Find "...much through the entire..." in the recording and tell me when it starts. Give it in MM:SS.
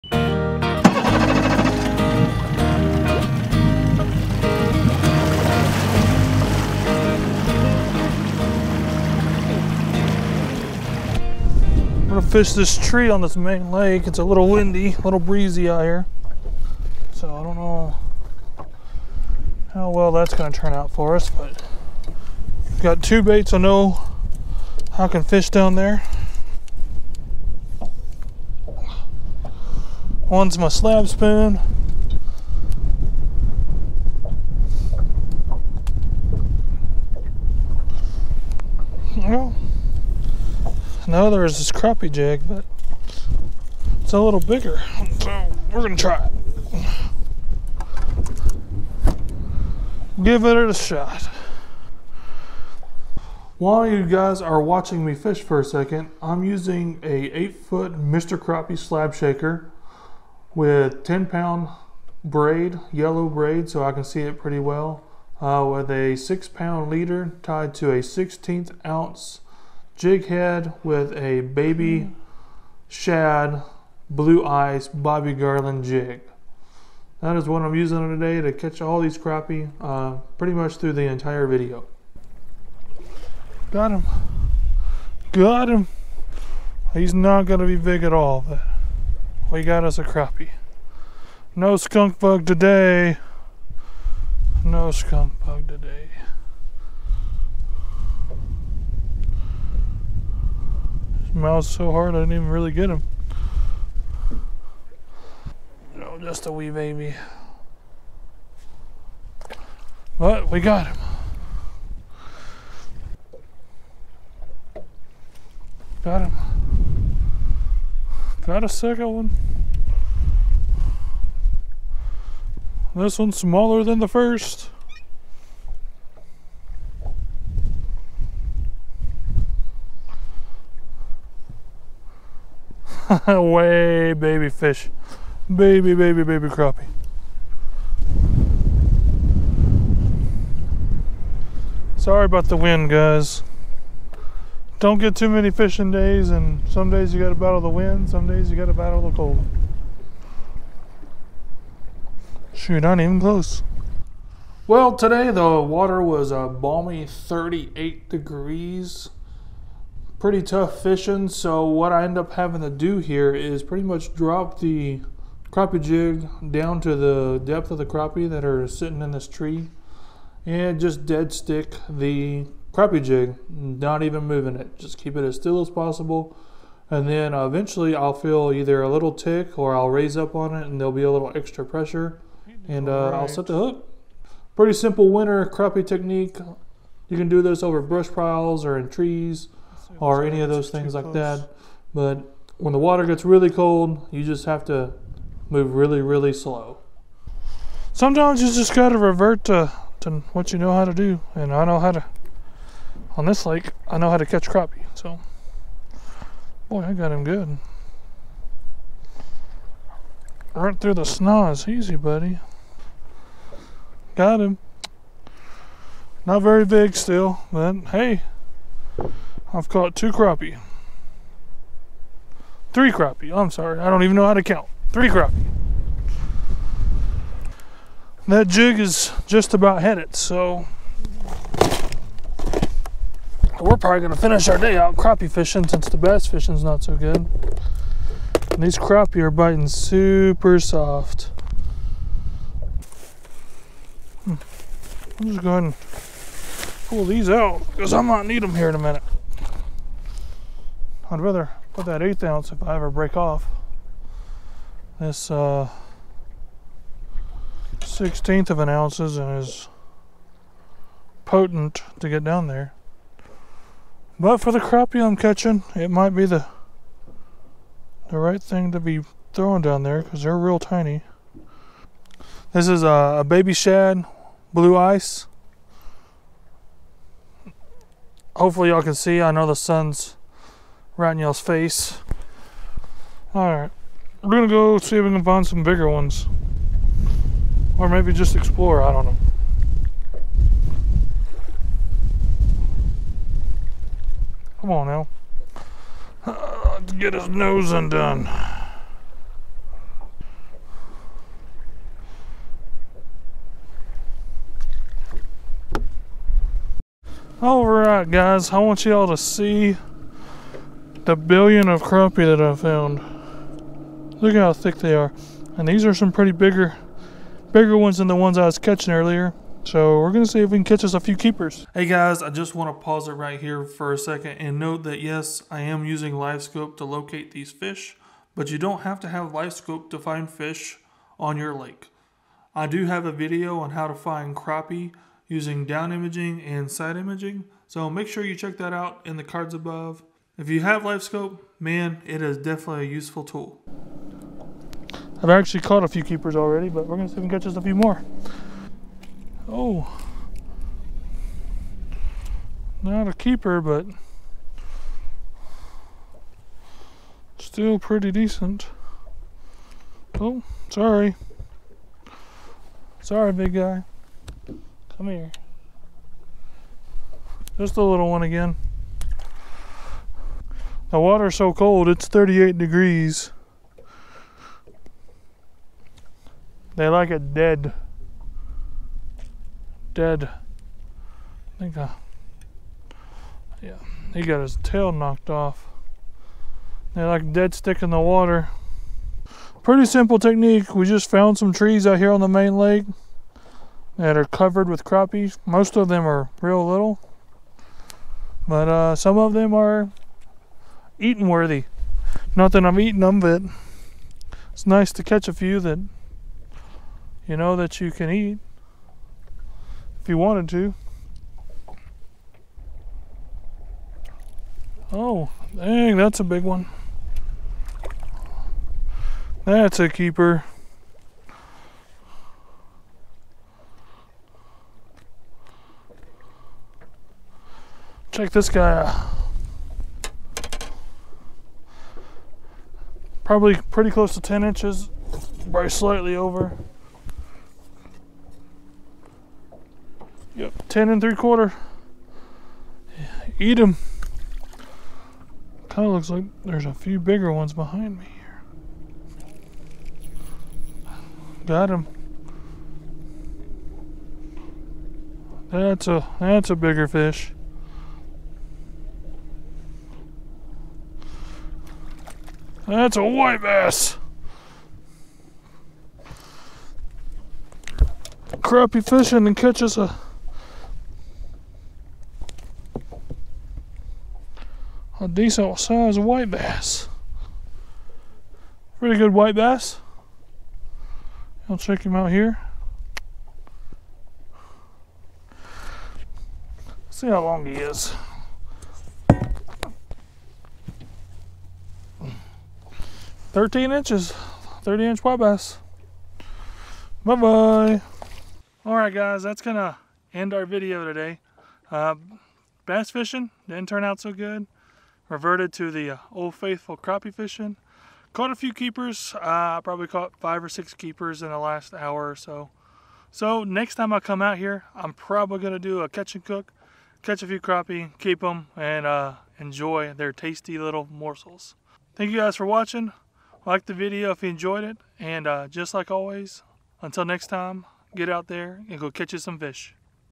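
01:20.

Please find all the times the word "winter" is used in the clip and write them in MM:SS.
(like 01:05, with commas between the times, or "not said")
03:05.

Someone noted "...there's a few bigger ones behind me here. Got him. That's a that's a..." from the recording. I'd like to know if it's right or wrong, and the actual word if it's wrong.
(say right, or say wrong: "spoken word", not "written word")
right.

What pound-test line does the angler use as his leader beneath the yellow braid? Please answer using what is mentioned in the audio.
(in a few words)
6 pound.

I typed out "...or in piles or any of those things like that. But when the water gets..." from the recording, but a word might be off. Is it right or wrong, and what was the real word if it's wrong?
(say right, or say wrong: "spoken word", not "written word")
wrong: "trees", not "piles".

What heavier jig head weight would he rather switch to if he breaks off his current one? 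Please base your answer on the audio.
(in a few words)
1/8 ounce.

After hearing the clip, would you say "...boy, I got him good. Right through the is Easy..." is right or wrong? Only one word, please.
right.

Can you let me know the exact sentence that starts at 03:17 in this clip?
Sometimes you just got to revert to, to what you know how to do.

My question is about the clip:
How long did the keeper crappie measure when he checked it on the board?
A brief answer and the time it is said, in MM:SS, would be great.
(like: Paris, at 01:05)
10 3/4 inches, at 07:20.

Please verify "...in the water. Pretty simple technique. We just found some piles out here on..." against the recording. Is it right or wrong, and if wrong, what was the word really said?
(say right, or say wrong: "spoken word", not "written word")
wrong: "trees", not "piles".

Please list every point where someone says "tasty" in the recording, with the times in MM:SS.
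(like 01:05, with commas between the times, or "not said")
08:40.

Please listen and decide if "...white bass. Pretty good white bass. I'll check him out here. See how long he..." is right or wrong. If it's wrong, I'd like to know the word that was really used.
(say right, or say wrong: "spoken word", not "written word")
right.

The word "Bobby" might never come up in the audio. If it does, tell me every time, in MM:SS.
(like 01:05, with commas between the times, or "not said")
01:14.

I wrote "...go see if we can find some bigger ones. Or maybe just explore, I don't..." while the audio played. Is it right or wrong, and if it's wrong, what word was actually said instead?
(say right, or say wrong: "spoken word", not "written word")
right.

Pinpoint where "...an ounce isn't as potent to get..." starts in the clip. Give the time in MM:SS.
04:18.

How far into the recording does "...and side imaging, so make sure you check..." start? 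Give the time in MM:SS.
05:36.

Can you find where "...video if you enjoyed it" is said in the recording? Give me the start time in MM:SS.
08:43.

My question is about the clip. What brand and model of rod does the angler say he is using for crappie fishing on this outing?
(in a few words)
Mr. Crappie Slab Shaker.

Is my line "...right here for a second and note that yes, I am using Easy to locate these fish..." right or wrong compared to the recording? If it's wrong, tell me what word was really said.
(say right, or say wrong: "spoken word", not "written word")
wrong: "LiveScope", not "Easy".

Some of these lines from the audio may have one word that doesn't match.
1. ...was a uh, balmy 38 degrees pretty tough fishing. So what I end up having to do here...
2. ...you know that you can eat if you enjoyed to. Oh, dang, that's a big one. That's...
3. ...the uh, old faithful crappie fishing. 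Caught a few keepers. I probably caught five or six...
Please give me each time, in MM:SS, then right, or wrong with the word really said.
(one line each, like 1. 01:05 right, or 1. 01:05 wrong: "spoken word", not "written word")
1. 02:36 right
2. 06:47 wrong: "wanted", not "enjoyed"
3. 08:25 right.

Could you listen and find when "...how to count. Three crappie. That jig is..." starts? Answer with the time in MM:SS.
03:44.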